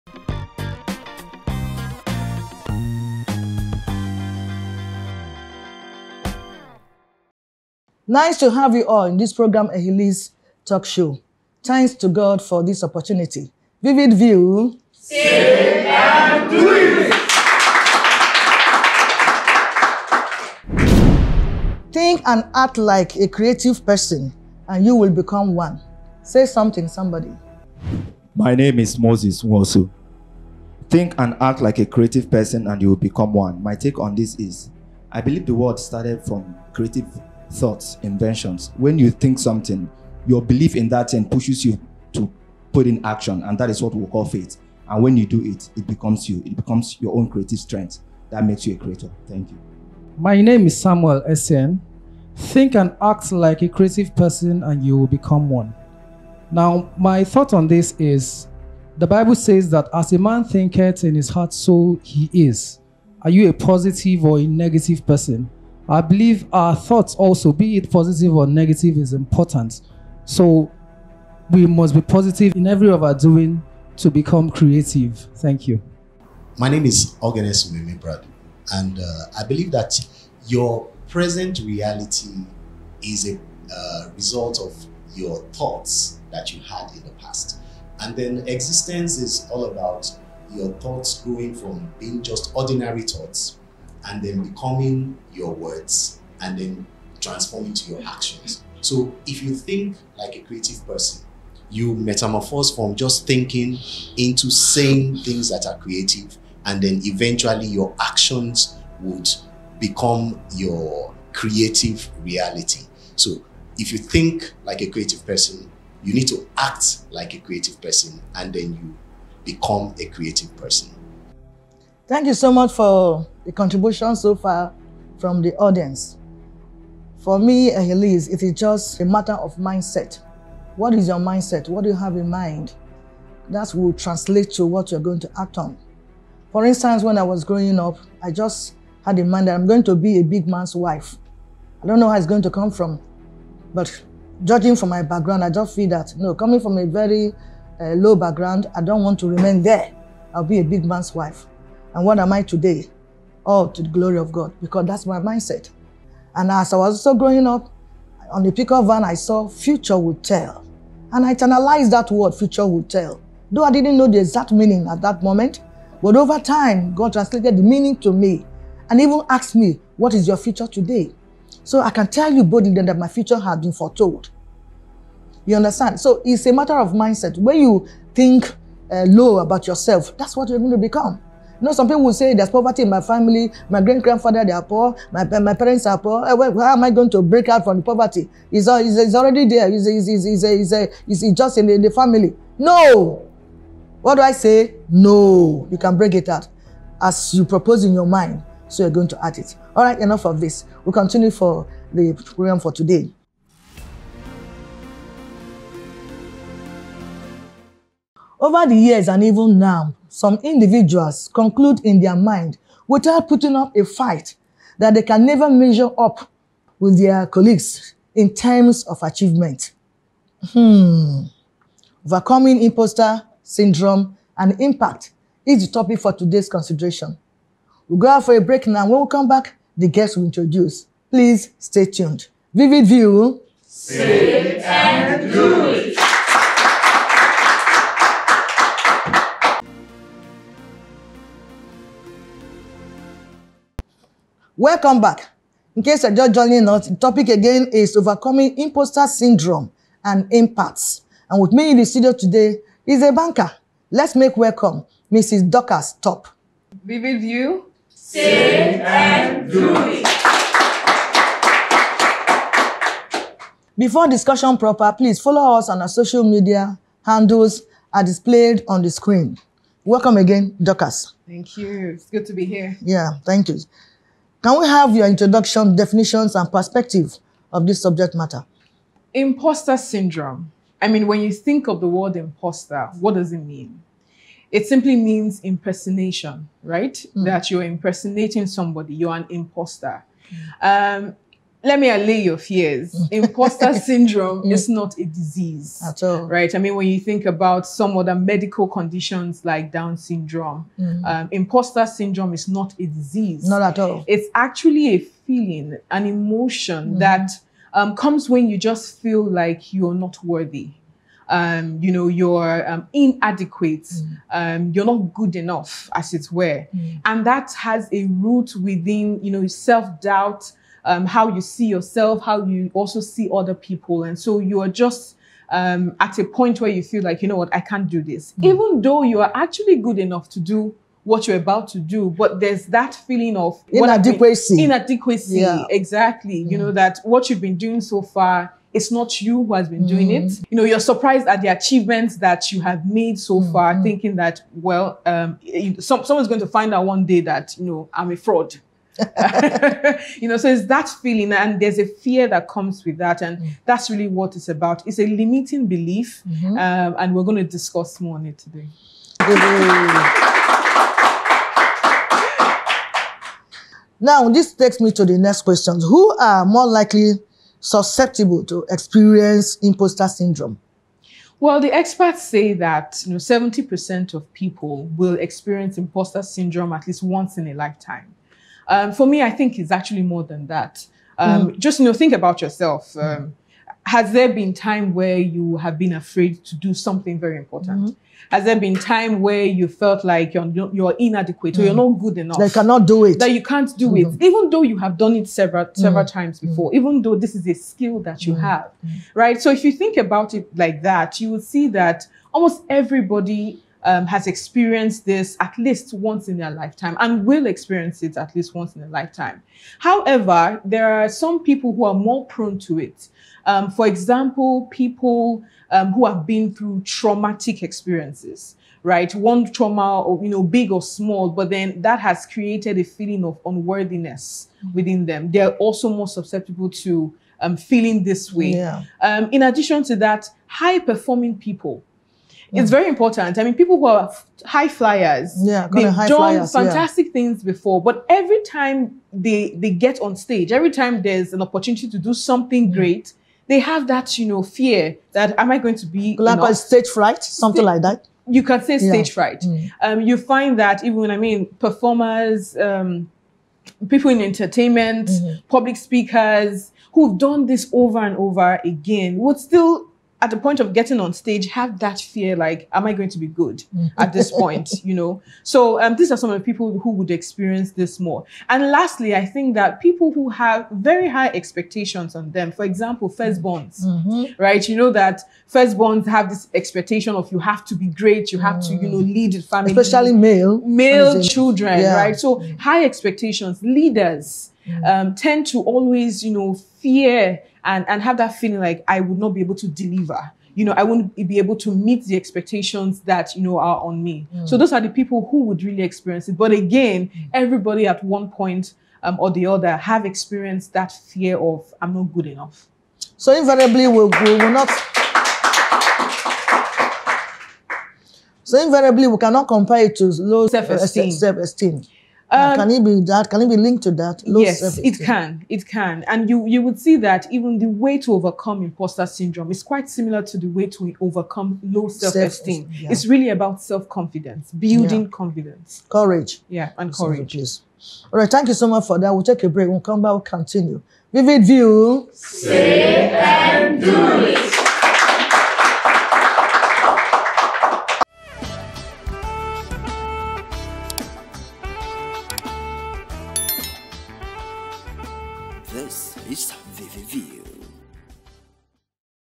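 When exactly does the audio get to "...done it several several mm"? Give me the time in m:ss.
6:35.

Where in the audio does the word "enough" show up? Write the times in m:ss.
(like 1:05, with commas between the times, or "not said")
3:19, 5:15, 5:29, 6:32, 8:22.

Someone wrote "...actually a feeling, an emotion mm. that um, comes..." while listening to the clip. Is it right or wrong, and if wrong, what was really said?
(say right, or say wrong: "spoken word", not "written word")
right.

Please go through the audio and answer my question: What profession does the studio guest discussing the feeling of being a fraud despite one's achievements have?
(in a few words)
Banker.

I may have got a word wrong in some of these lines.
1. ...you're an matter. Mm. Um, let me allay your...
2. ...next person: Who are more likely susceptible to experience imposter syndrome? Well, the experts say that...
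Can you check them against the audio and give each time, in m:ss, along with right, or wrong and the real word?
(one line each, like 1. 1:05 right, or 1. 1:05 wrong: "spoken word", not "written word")
1. 4:48 wrong: "imposter", not "matter"
2. 6:05 wrong: "question", not "person".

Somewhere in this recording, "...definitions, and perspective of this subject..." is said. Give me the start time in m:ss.
4:35.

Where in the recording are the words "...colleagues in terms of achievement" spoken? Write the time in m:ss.
3:37.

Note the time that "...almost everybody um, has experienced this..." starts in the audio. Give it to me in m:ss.
6:42.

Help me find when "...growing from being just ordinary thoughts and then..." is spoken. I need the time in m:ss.
1:31.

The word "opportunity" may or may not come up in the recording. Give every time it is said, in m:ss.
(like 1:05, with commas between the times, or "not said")
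0:12, 7:21.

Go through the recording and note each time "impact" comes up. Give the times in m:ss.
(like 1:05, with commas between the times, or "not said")
3:44, 4:10.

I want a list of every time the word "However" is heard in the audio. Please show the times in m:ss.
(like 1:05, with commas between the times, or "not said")
6:49.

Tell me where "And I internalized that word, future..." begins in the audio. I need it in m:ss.
2:41.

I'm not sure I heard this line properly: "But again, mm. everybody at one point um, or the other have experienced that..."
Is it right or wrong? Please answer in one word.
right.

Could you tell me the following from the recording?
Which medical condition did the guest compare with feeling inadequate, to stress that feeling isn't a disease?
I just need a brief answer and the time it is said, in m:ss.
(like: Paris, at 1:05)
Down syndrome, at 4:59.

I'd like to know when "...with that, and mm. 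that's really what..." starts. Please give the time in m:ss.
5:52.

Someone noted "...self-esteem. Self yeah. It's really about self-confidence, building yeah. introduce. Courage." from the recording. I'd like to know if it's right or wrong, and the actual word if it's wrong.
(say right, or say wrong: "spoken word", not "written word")
wrong: "confidence", not "introduce".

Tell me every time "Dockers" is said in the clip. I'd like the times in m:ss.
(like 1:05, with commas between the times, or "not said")
4:15, 4:30.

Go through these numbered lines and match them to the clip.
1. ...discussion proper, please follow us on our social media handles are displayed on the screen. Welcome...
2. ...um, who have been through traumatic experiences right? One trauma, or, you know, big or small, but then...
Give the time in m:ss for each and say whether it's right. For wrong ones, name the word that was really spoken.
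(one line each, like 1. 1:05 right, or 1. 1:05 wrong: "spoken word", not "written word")
1. 4:24 right
2. 6:55 right.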